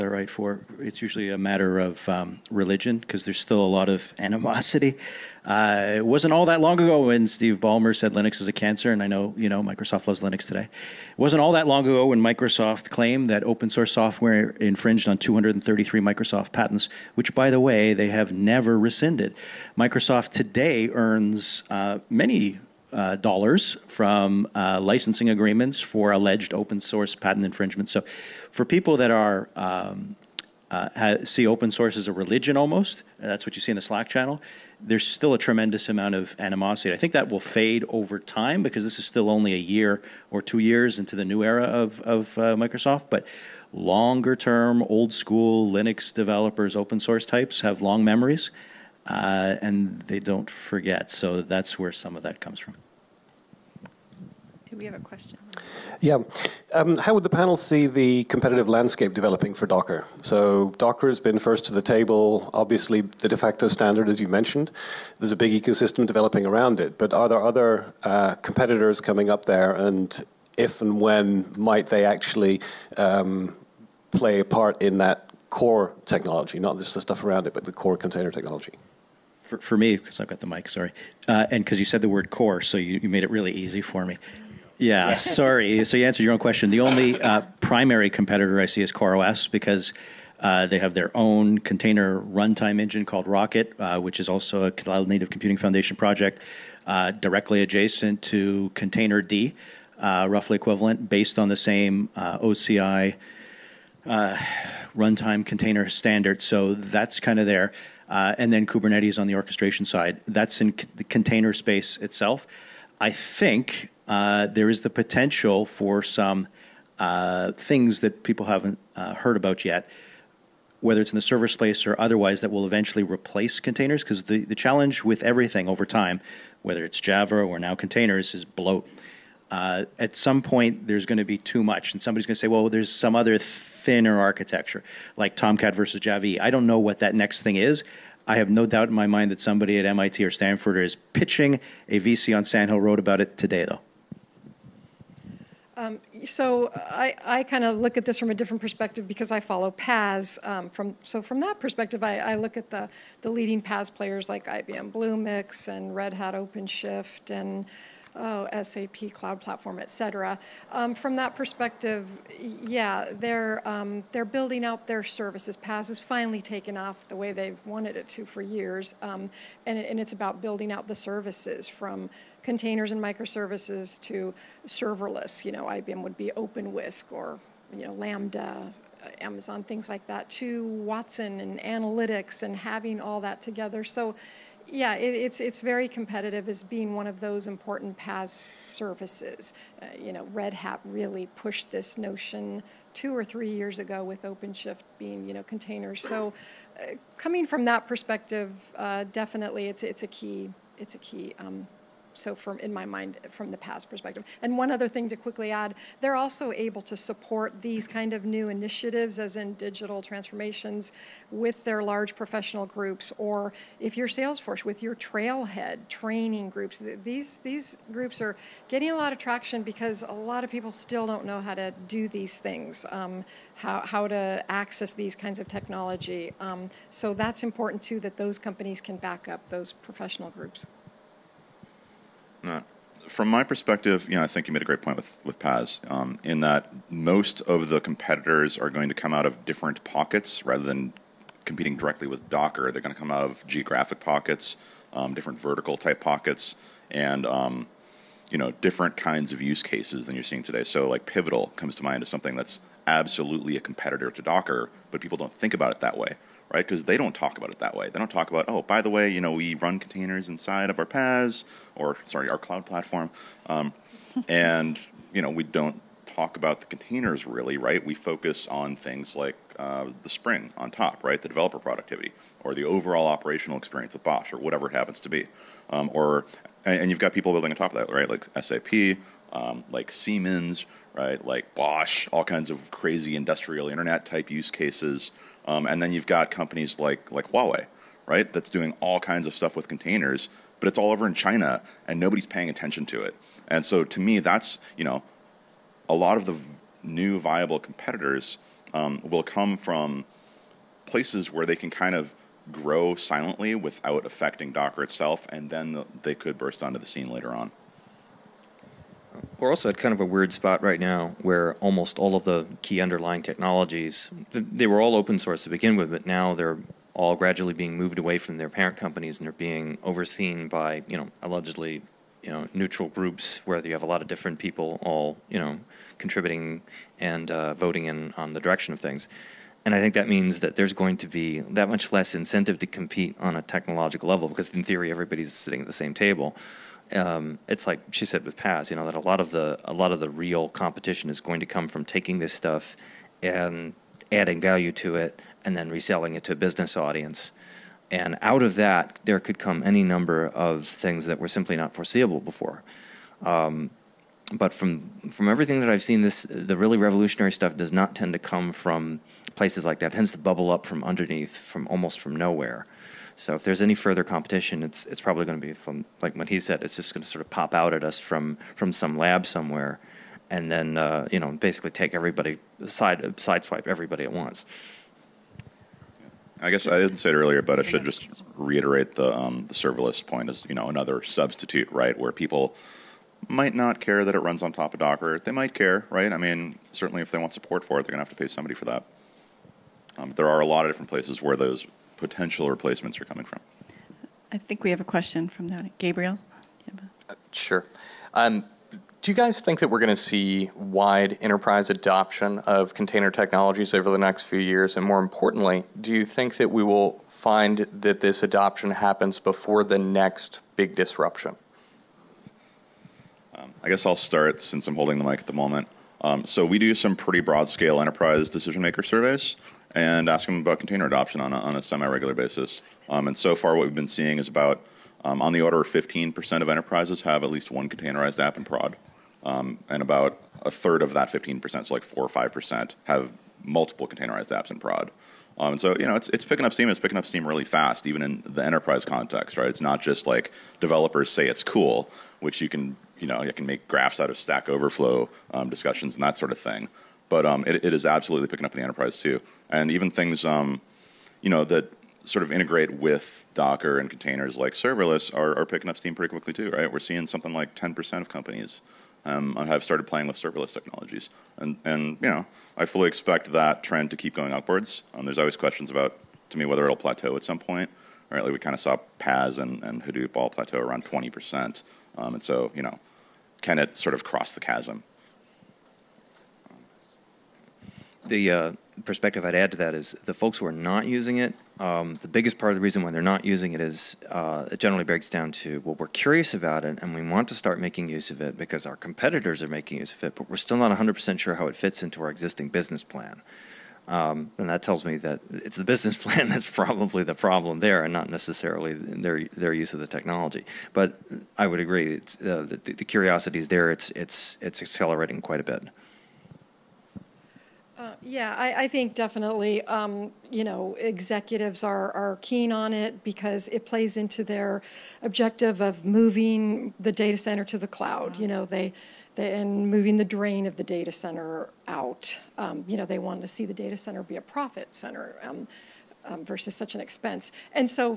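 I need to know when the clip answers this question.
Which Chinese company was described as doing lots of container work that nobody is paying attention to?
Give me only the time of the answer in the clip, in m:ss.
4:47.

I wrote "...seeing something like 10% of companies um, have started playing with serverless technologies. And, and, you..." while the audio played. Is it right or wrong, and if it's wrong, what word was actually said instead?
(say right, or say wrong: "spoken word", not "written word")
right.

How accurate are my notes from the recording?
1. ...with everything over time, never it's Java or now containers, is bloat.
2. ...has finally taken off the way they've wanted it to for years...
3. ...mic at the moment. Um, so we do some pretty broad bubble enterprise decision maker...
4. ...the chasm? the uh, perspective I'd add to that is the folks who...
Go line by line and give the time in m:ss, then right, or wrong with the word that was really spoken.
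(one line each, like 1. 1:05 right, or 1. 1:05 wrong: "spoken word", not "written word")
1. 2:05 wrong: "whether", not "never"
2. 2:45 right
3. 6:55 wrong: "scale", not "bubble"
4. 7:54 right.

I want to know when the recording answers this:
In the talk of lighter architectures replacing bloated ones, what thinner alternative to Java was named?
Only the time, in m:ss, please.
2:15.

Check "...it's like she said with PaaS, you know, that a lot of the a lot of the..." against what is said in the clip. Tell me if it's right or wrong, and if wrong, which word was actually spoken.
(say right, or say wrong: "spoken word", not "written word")
right.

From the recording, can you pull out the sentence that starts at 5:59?
It tends to bubble up from underneath, from almost from nowhere.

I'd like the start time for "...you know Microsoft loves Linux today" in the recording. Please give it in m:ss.
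0:09.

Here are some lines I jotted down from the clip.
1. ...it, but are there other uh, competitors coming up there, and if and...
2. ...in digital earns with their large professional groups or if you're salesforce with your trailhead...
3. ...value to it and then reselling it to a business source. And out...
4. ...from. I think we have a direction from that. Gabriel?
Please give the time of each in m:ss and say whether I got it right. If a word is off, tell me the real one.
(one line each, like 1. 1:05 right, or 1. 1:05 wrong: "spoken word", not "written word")
1. 1:06 right
2. 3:29 wrong: "transformations", not "earns"
3. 5:44 wrong: "audience", not "source"
4. 6:33 wrong: "question", not "direction".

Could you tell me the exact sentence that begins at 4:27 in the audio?
We focus on things like uh, the Spring on top, right?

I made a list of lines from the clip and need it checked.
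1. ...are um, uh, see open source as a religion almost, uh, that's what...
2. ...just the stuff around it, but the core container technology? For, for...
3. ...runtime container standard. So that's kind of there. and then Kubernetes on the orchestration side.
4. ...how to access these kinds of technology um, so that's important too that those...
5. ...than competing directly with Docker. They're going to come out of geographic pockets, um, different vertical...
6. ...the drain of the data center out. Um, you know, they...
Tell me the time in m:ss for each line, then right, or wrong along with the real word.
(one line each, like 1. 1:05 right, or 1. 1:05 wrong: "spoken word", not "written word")
1. 0:29 right
2. 1:16 right
3. 1:44 right
4. 3:43 right
5. 4:00 right
6. 8:39 right.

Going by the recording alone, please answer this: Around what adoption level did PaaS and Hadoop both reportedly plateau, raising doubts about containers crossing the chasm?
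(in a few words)
20%.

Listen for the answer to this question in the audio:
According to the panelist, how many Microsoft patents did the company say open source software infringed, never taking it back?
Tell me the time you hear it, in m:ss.
0:15.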